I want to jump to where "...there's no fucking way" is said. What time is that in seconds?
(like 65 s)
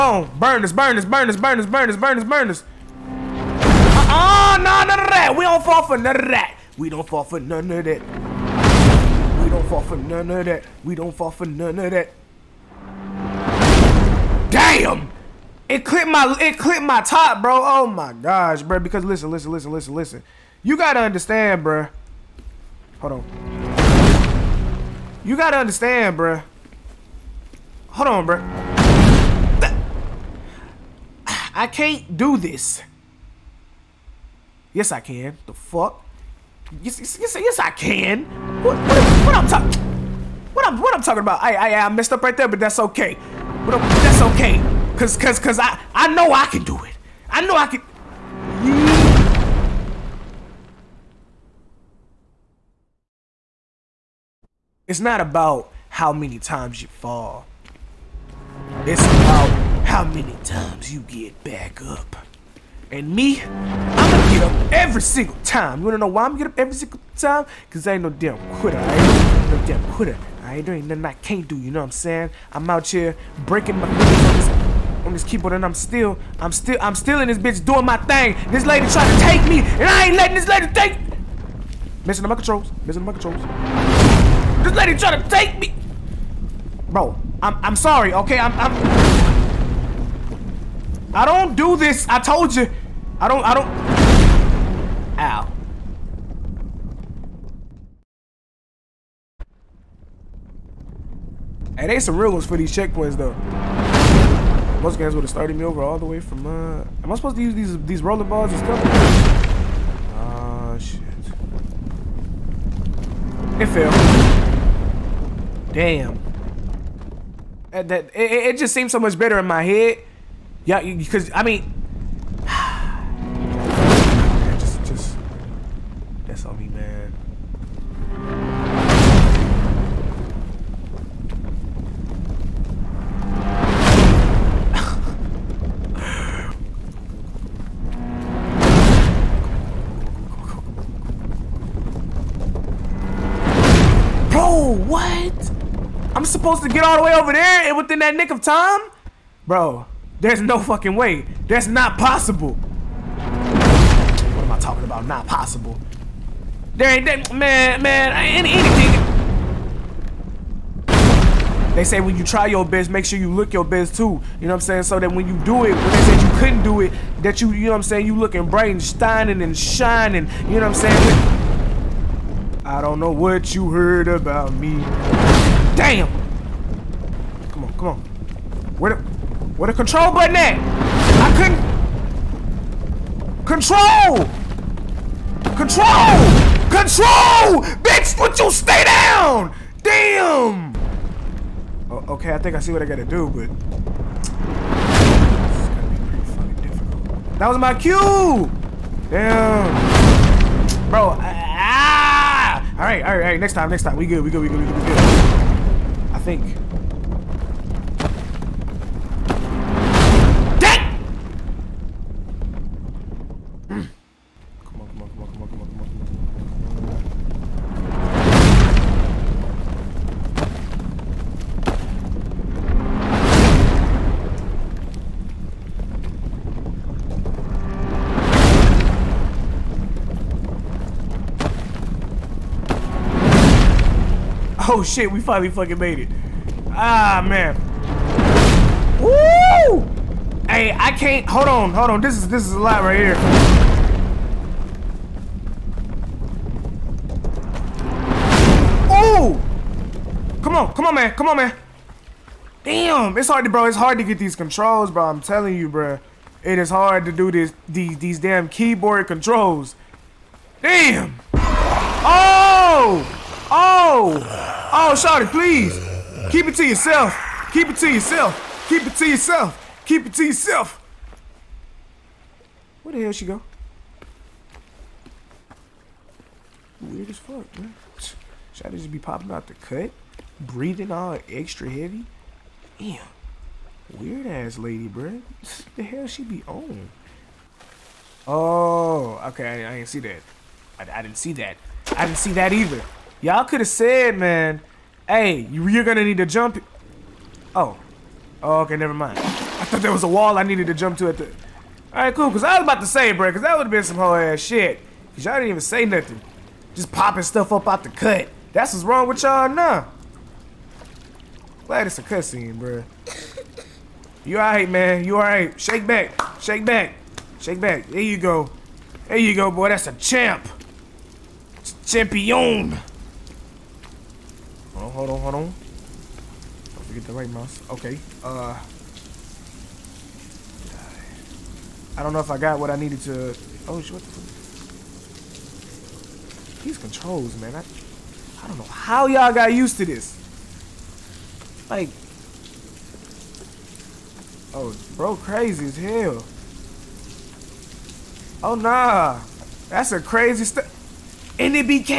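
150 s.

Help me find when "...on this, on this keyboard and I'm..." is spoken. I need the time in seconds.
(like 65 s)
74 s.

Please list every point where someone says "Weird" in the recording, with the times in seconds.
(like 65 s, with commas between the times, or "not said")
276 s, 283 s.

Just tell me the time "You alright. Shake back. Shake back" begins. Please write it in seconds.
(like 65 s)
315 s.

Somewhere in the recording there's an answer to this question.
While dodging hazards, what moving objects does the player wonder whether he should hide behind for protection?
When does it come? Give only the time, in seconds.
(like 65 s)
108 s.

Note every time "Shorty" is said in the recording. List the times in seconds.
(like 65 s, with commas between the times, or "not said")
264 s, 278 s.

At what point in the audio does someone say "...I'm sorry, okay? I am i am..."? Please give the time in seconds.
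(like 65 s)
87 s.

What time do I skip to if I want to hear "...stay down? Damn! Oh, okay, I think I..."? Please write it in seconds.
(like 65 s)
188 s.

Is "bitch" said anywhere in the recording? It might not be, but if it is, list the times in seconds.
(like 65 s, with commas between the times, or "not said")
77 s, 187 s.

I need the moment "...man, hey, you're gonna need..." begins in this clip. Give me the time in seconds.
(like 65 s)
294 s.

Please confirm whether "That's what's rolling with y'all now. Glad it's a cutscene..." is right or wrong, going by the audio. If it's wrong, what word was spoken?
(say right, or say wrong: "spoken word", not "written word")
wrong: "wrong", not "rolling".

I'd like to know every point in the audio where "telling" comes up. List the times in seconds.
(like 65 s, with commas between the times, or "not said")
255 s.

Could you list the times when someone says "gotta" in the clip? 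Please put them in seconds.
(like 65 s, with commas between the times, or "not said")
20 s, 25 s, 192 s.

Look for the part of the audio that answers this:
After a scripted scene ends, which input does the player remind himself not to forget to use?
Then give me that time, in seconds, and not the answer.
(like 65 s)
327 s.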